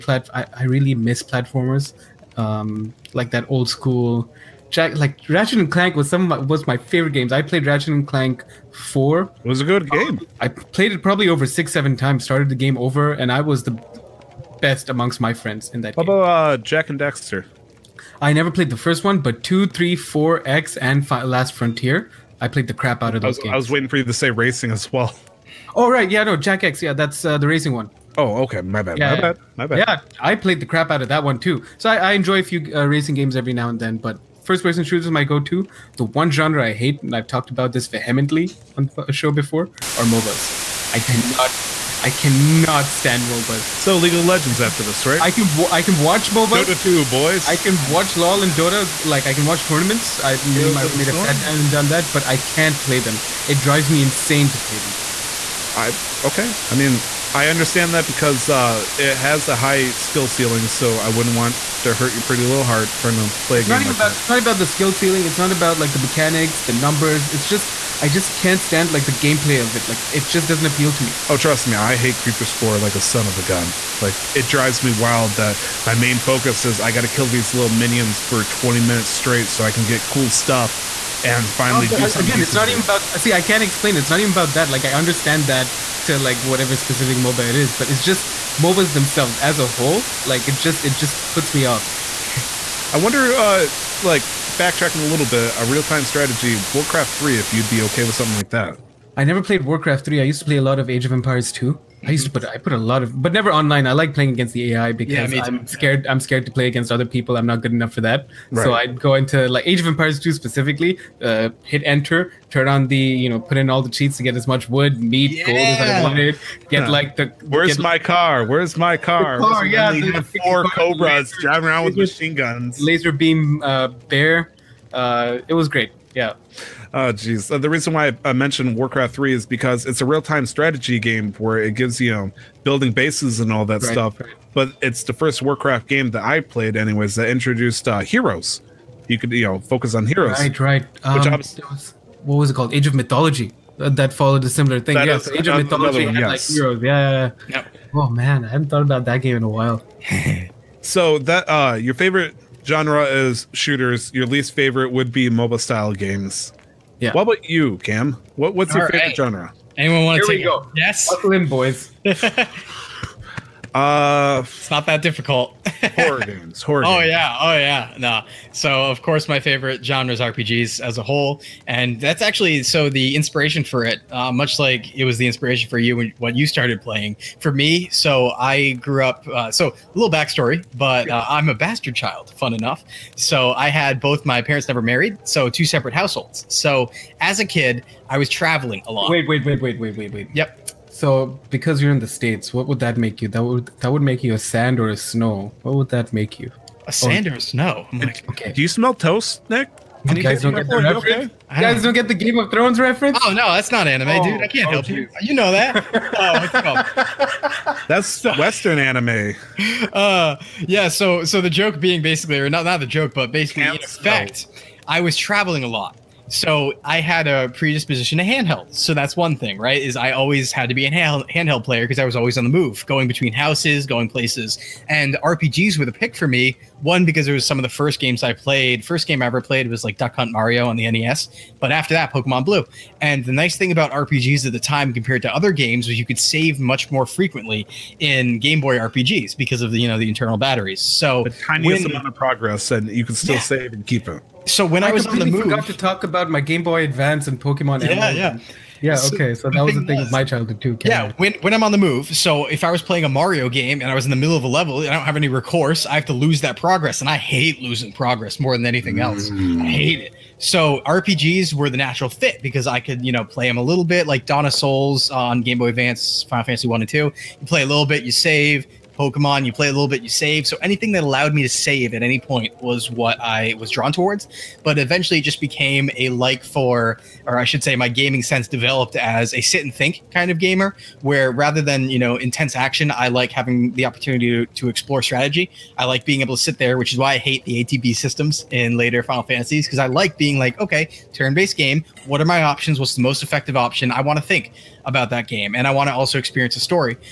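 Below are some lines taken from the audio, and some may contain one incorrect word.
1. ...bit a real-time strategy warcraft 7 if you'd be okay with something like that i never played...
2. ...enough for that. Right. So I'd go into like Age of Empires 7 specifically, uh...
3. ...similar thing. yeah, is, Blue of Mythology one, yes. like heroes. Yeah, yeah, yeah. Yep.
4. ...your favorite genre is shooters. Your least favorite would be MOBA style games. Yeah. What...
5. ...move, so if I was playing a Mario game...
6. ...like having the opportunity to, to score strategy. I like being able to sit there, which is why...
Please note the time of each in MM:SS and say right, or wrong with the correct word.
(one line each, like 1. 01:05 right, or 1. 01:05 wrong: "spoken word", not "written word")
1. 01:35 wrong: "3", not "7"
2. 01:47 wrong: "2", not "7"
3. 02:24 wrong: "Age", not "Blue"
4. 02:31 right
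5. 04:11 right
6. 04:43 wrong: "explore", not "score".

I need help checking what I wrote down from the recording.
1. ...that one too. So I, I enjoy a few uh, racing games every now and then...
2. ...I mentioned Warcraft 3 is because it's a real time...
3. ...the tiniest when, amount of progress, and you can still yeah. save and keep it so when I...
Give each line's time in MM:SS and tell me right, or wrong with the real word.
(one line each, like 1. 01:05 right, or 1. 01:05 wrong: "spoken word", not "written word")
1. 00:31 right
2. 02:08 right
3. 04:01 right.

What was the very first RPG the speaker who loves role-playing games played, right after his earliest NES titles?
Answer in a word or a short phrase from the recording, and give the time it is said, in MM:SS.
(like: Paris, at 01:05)
Pokemon Blue, at 03:52.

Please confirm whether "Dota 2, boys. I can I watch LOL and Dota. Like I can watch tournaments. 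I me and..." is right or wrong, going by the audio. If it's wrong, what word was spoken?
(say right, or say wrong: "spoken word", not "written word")
right.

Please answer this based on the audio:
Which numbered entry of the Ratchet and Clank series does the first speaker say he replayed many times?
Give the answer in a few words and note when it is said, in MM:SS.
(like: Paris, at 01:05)
4, at 00:07.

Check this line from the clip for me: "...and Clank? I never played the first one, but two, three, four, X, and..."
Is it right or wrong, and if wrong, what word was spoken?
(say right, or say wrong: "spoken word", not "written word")
wrong: "Daxter", not "Clank".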